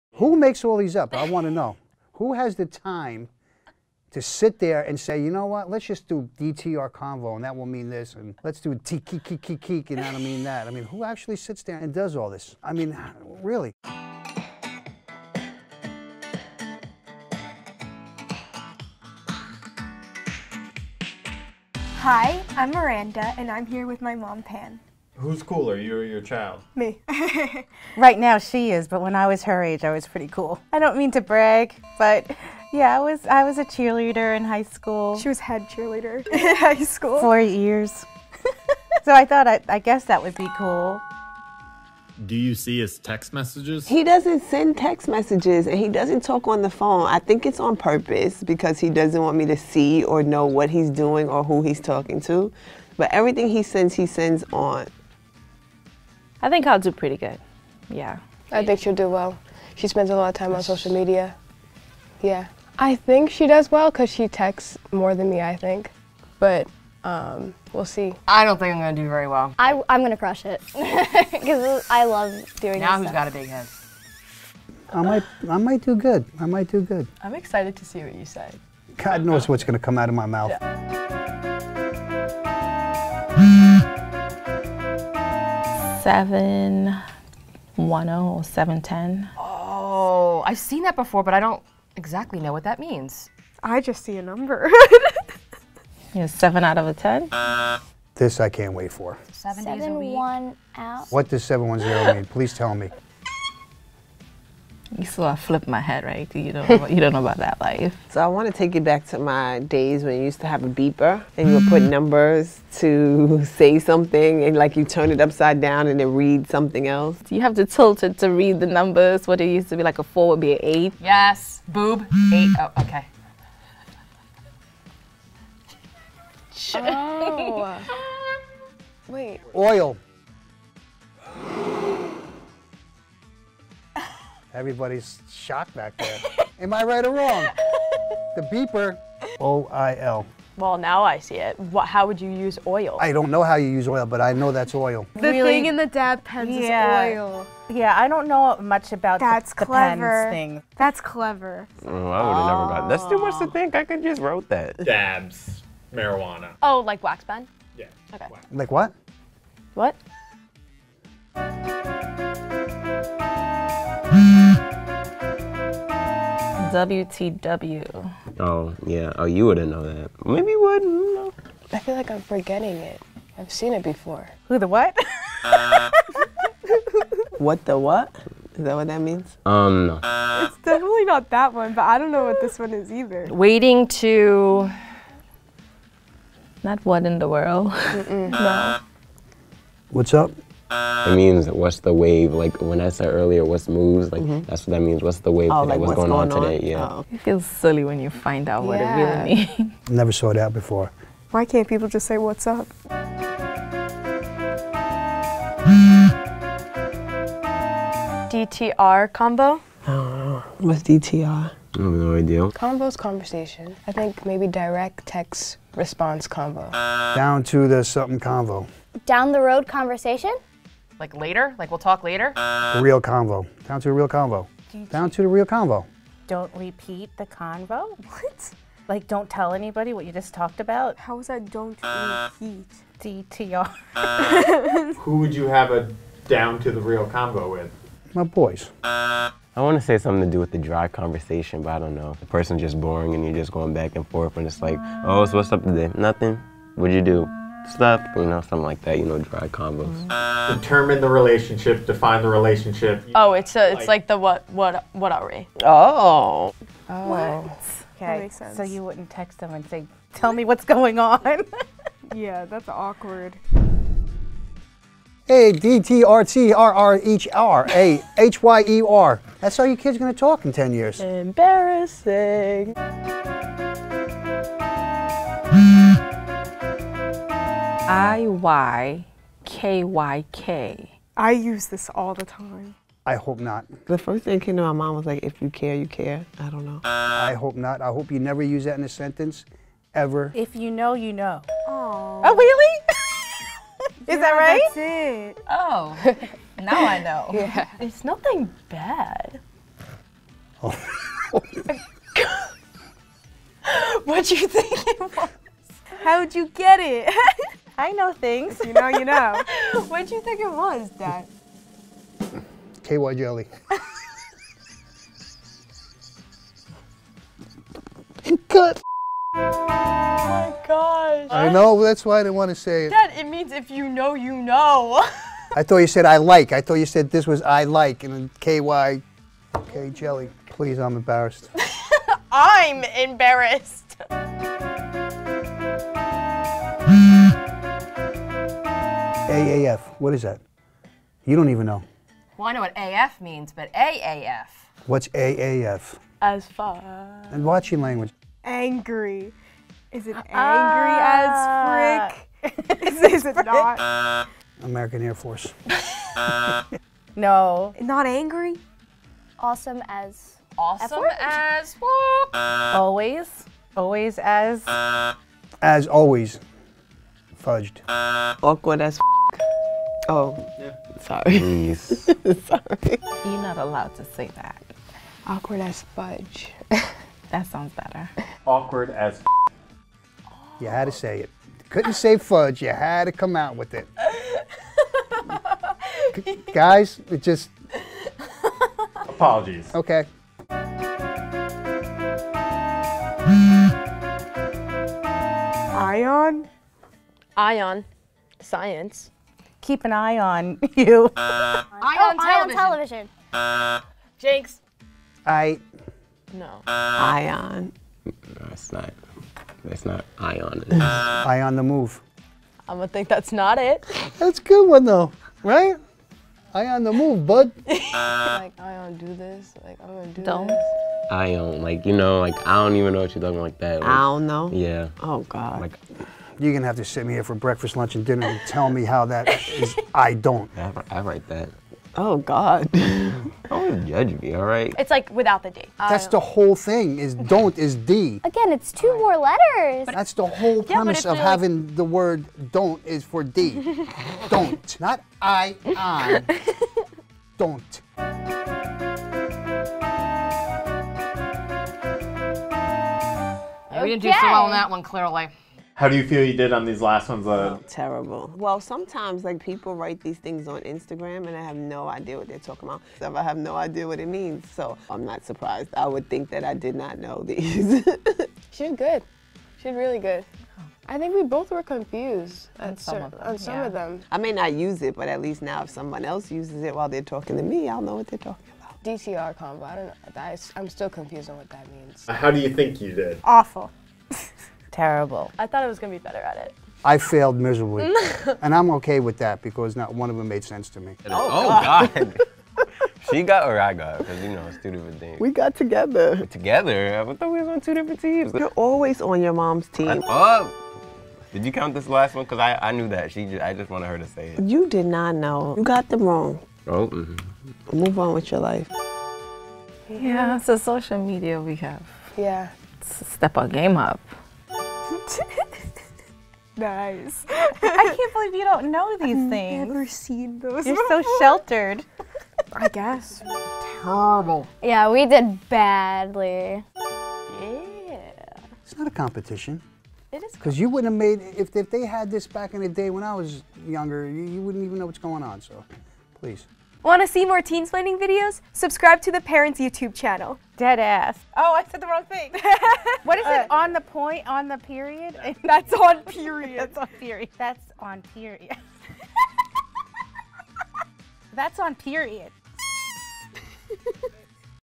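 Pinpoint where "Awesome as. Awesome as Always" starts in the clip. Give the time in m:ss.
5:59.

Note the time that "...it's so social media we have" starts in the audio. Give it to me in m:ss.
8:30.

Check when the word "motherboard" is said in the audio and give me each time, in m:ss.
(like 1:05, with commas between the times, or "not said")
not said.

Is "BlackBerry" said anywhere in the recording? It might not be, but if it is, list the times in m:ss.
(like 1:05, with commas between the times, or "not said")
not said.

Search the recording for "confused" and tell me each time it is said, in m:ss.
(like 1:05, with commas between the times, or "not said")
7:51, 8:00.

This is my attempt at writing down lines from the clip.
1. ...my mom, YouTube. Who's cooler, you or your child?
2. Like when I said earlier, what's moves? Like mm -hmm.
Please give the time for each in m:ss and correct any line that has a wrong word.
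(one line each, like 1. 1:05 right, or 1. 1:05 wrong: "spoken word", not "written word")
1. 0:24 wrong: "Pam", not "YouTube"
2. 3:12 right.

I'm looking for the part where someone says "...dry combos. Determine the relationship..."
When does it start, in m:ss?
4:09.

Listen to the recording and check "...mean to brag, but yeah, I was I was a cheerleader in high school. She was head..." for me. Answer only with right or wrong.
right.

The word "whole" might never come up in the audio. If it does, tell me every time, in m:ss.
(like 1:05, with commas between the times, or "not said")
7:16, 7:20.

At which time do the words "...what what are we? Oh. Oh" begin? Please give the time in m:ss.
4:14.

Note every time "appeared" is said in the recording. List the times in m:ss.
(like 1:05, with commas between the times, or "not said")
not said.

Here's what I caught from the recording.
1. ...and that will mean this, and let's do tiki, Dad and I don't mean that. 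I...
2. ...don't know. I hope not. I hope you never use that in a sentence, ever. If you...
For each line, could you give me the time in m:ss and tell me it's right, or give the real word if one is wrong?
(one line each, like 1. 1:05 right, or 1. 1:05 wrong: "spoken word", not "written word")
1. 0:07 wrong: "TKKKK", not "Dad"
2. 4:46 right.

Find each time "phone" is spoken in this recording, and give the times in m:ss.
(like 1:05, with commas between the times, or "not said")
0:46.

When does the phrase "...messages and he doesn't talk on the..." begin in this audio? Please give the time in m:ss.
0:45.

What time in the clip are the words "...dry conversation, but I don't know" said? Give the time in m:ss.
4:00.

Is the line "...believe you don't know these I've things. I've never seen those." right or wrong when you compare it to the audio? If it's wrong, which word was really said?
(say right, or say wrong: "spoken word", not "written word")
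right.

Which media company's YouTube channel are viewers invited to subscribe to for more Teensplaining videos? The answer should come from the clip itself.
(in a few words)
Parents.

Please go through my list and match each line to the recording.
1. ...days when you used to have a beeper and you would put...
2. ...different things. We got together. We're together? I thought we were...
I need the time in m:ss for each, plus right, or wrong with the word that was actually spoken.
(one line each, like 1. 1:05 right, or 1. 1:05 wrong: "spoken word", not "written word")
1. 1:49 right
2. 8:14 right.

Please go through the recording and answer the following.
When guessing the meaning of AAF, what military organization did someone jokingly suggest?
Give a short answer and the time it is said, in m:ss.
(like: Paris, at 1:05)
American Air Force, at 5:54.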